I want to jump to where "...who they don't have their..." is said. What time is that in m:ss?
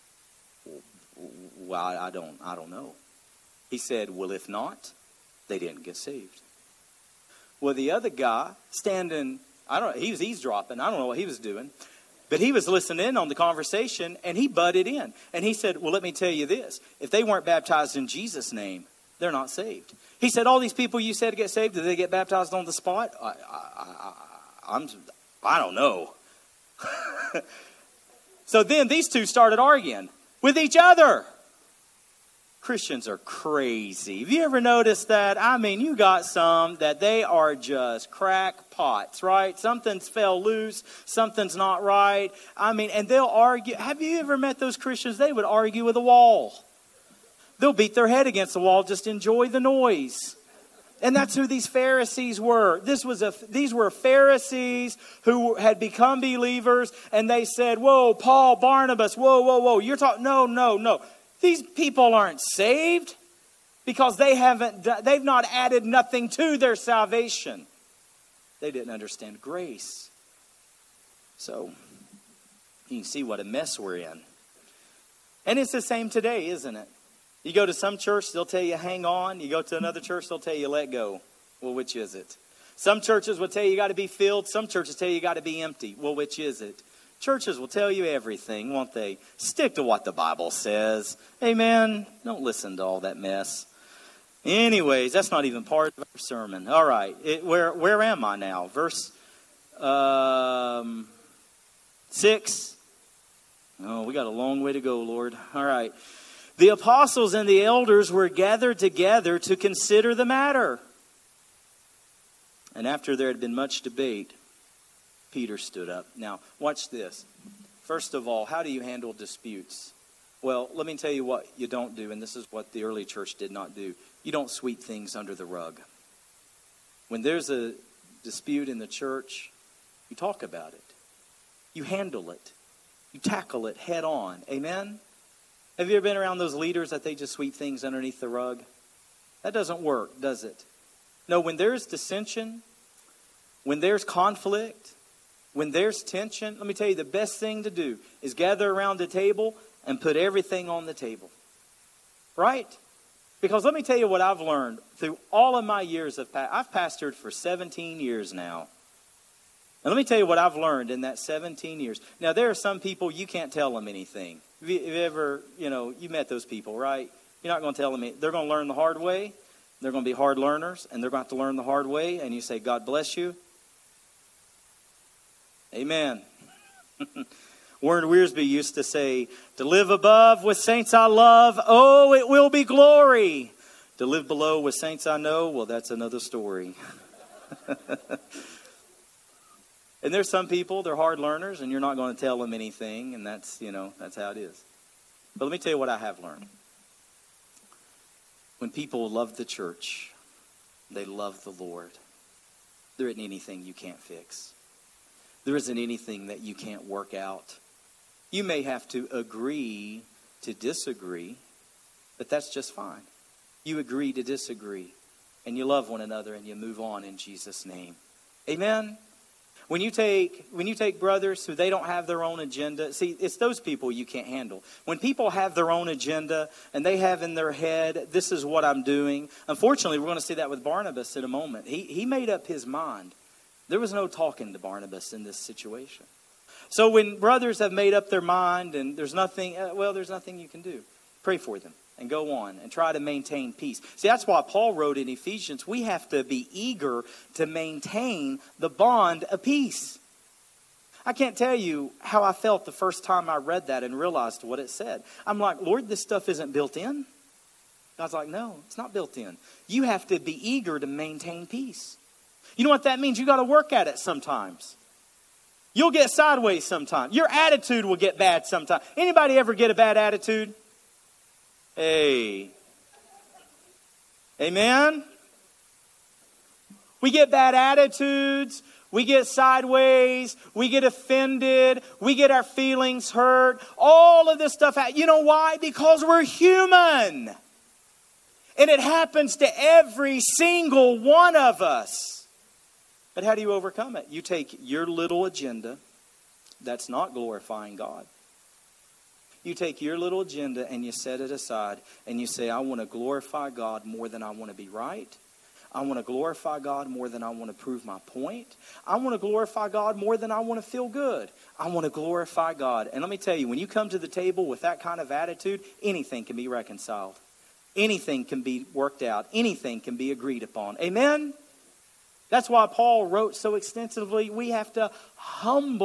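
3:41.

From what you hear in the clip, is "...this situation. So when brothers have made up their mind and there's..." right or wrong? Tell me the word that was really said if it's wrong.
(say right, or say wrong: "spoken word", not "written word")
right.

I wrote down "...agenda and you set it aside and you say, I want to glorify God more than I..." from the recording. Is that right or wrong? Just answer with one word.
right.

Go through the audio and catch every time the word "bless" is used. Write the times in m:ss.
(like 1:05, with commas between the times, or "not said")
2:52.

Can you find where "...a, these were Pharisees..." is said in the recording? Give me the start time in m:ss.
0:53.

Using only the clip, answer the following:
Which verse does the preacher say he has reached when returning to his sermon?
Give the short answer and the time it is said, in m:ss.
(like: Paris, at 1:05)
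Verse 6, at 1:38.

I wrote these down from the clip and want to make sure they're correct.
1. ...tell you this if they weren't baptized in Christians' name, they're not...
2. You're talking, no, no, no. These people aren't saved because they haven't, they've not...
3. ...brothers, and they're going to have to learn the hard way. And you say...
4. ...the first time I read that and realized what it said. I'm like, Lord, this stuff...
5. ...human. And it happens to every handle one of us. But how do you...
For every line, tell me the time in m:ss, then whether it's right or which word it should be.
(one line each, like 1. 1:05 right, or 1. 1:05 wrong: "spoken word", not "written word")
1. 0:16 wrong: "Jesus", not "Christians"
2. 0:59 right
3. 2:50 wrong: "learners", not "brothers"
4. 4:12 right
5. 4:46 wrong: "single", not "handle".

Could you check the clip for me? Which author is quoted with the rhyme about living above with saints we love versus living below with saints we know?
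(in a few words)
Warren Wiersbe.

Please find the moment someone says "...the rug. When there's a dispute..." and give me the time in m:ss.
2:05.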